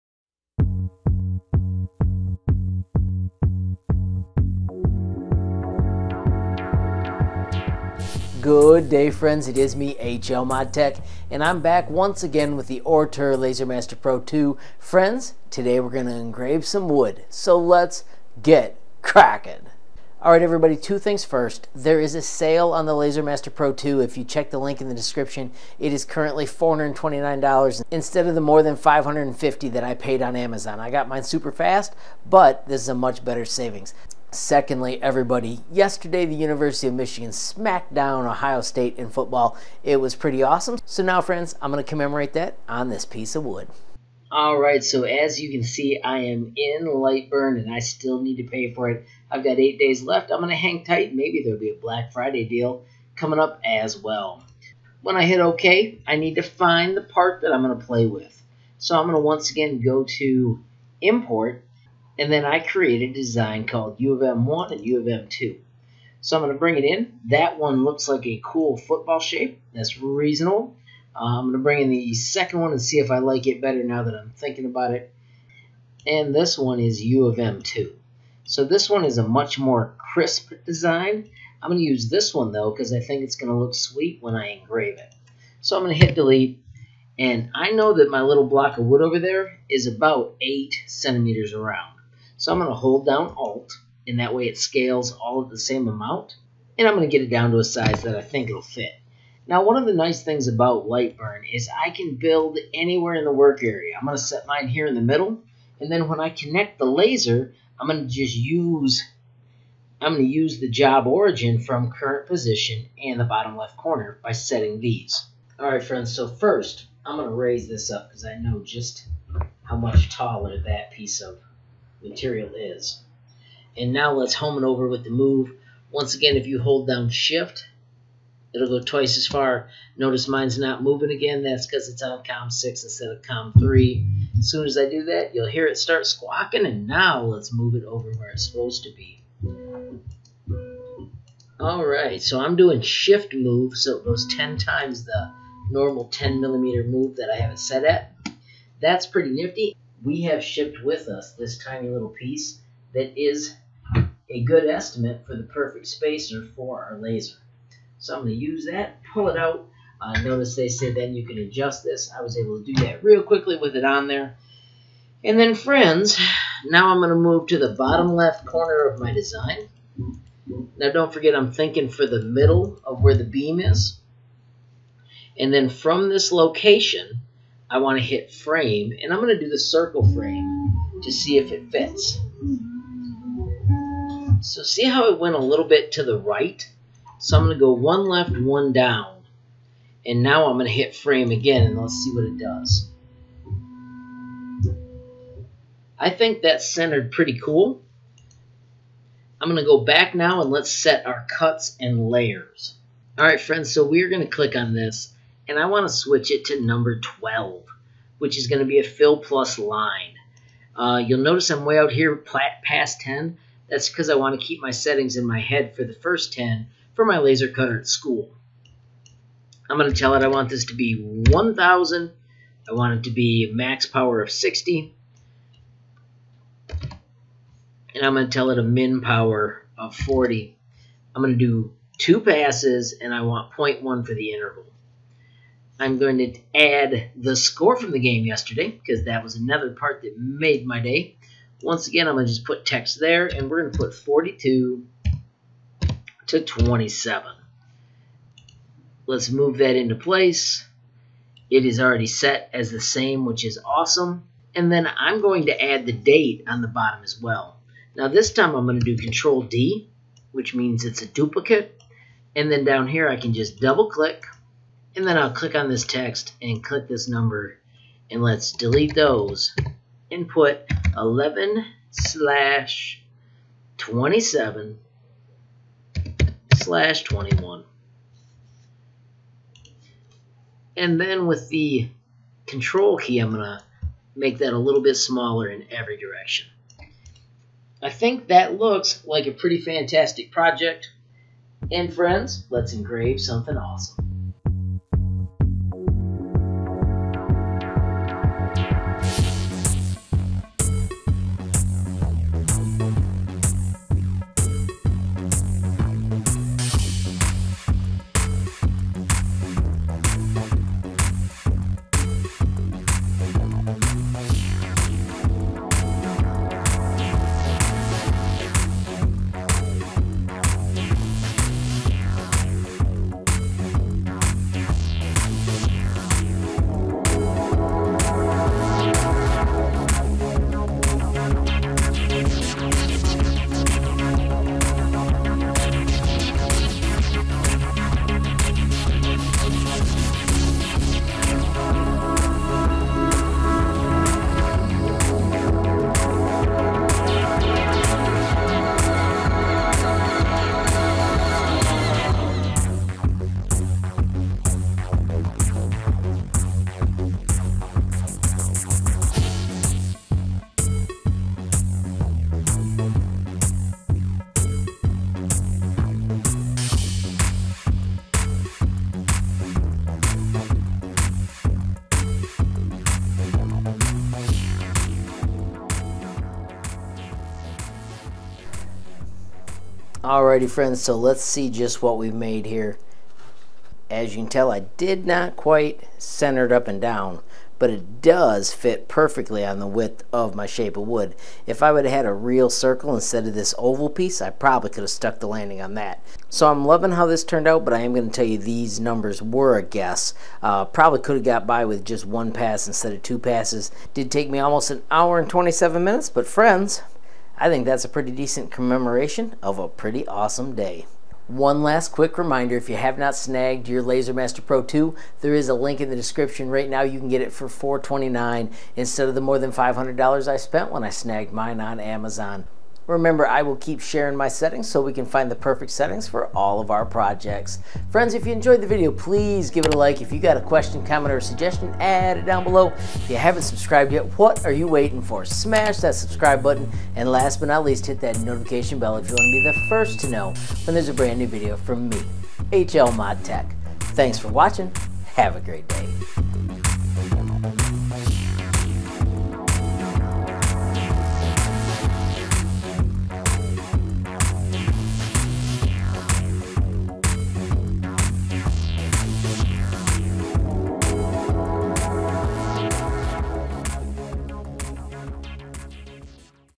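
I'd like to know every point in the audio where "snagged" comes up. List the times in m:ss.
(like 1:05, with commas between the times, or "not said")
6:53, 7:00.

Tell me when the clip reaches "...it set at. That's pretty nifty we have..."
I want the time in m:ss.
2:27.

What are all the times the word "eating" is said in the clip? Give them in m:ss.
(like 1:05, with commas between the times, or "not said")
not said.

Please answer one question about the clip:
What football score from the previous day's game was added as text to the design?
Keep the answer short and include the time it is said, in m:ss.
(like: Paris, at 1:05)
42 to 27, at 4:03.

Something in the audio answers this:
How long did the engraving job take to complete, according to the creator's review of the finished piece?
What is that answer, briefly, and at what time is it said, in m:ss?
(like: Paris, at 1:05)
1 hour 27 minutes, at 6:44.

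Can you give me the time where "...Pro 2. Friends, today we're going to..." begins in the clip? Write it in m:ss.
0:14.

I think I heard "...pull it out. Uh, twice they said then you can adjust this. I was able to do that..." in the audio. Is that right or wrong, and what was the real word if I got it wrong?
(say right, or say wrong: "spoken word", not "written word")
wrong: "notice", not "twice".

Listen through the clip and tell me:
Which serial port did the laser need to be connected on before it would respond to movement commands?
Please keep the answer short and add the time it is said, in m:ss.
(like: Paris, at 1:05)
COM6, at 2:12.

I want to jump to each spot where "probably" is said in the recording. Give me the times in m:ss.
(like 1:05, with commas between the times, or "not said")
6:34, 6:40.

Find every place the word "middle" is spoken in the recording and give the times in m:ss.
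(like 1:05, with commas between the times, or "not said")
1:45, 2:52.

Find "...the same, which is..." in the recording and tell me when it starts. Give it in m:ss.
4:12.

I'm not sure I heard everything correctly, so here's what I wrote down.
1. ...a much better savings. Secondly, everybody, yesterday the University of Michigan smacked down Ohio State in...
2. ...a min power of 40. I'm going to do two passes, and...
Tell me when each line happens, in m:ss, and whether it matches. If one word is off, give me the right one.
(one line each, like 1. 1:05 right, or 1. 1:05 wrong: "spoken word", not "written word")
1. 0:32 right
2. 3:48 right.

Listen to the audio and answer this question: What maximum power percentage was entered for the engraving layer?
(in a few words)
60.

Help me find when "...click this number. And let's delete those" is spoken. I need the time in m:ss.
4:26.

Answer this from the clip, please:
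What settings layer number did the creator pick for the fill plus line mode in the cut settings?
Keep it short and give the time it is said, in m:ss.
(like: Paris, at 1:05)
12, at 3:26.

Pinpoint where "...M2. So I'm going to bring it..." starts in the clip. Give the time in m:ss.
1:05.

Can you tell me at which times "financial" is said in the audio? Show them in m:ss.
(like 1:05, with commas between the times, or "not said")
not said.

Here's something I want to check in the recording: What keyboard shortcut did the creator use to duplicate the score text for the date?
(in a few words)
Control D.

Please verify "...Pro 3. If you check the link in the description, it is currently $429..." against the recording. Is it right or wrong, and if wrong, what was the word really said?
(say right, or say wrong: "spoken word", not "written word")
wrong: "2", not "3".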